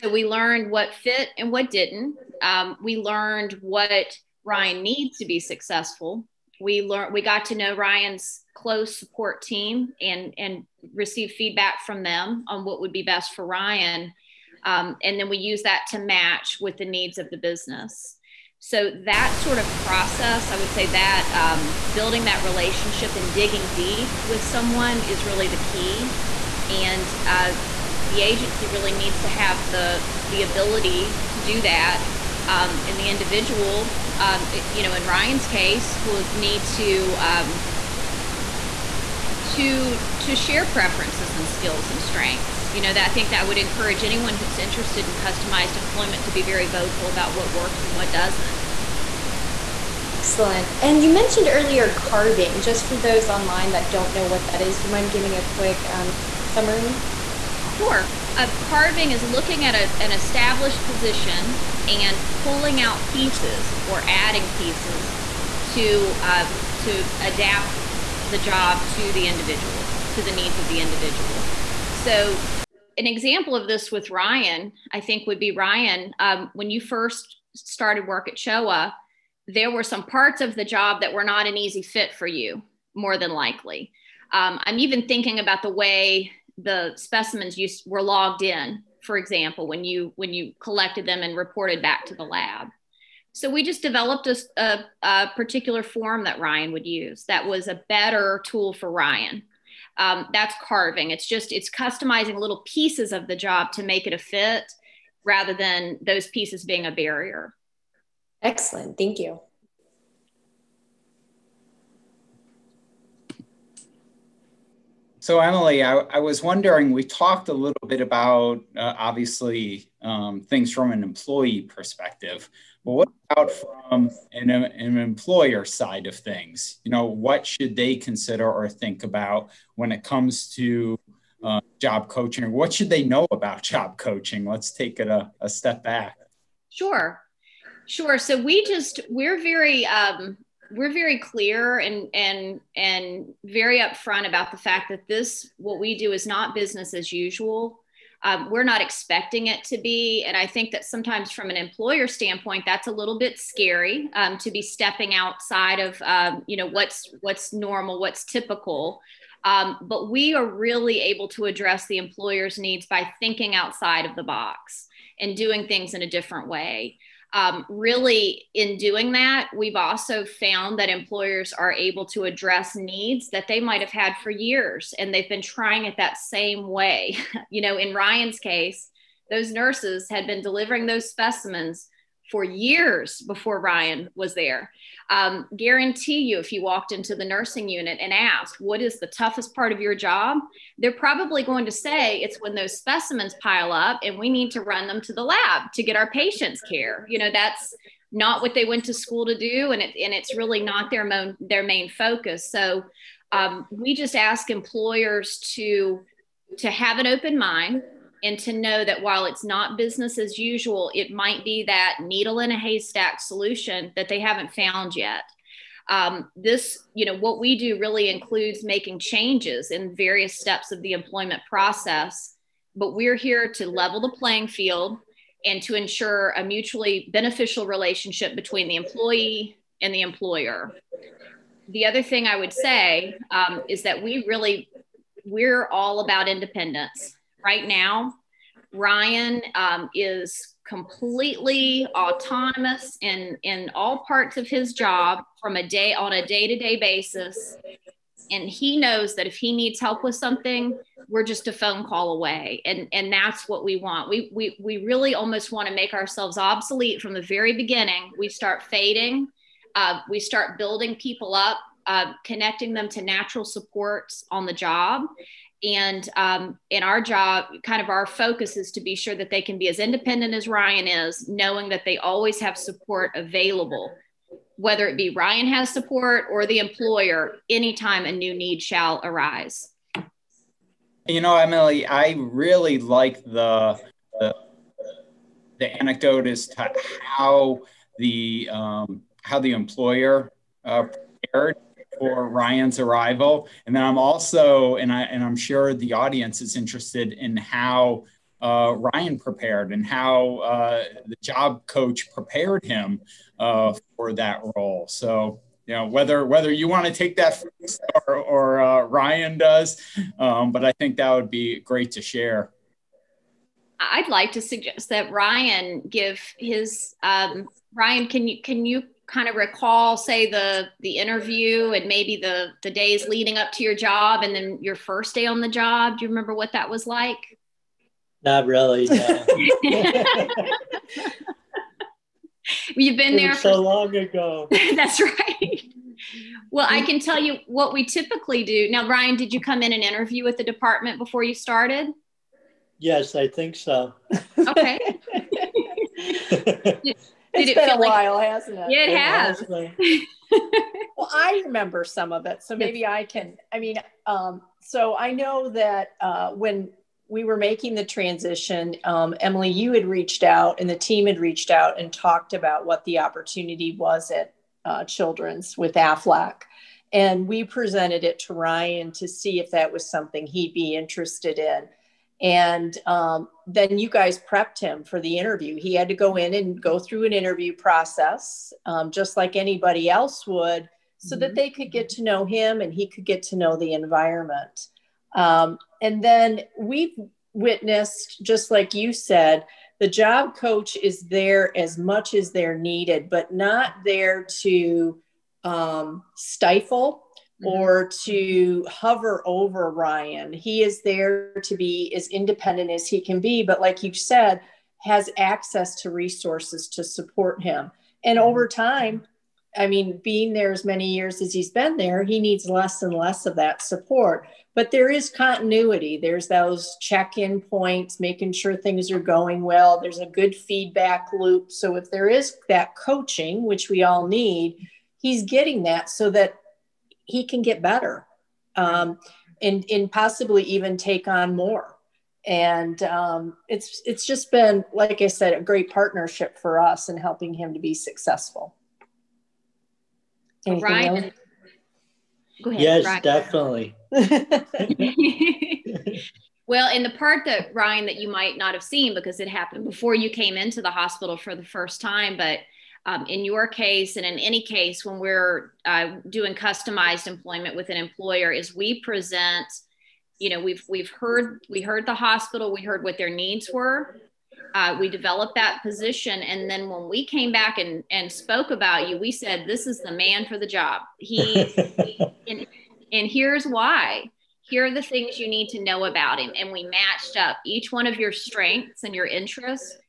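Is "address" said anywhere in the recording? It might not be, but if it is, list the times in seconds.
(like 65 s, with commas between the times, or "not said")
161 s, 172 s.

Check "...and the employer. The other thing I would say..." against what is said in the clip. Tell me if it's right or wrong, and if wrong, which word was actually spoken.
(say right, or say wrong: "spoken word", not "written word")
right.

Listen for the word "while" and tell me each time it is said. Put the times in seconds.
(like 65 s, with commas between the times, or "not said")
209 s, 347 s.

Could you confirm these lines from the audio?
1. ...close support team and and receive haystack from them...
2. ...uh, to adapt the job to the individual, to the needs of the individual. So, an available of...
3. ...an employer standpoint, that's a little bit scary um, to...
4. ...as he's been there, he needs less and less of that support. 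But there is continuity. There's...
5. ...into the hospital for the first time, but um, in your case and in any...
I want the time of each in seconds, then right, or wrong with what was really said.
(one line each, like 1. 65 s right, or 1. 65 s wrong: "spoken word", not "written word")
1. 8 s wrong: "feedback", not "haystack"
2. 66 s wrong: "example", not "available"
3. 151 s right
4. 411 s right
5. 450 s right.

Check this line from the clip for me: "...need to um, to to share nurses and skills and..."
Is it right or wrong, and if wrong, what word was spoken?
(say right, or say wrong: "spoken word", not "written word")
wrong: "preferences", not "nurses".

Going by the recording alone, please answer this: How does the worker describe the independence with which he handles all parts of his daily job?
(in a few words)
Completely autonomous.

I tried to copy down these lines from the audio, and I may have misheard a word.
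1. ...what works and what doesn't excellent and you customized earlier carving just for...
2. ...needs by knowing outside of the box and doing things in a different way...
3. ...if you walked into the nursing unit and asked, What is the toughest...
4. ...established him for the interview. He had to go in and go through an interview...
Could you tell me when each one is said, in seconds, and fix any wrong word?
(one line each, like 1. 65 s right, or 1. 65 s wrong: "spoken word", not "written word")
1. 47 s wrong: "mentioned", not "customized"
2. 162 s wrong: "thinking", not "knowing"
3. 186 s right
4. 374 s wrong: "prepped", not "established".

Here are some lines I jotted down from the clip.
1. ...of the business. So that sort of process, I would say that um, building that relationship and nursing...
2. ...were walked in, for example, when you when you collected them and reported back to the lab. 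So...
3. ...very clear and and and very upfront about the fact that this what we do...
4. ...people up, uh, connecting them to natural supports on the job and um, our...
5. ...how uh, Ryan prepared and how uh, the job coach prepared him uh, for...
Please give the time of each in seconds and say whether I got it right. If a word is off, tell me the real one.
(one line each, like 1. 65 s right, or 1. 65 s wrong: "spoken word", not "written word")
1. 17 s wrong: "digging", not "nursing"
2. 87 s wrong: "logged", not "walked"
3. 140 s right
4. 260 s right
5. 297 s right.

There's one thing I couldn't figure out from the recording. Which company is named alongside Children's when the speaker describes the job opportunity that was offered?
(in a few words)
AFLAC.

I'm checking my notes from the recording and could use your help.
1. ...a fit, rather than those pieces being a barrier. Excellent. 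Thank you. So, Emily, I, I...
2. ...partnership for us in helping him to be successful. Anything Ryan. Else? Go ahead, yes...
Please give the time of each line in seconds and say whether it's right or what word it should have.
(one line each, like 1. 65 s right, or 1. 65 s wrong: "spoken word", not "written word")
1. 104 s right
2. 435 s right.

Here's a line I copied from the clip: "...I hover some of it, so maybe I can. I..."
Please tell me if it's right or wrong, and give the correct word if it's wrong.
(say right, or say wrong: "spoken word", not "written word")
wrong: "remember", not "hover".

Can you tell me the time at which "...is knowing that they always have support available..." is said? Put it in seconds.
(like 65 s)
270 s.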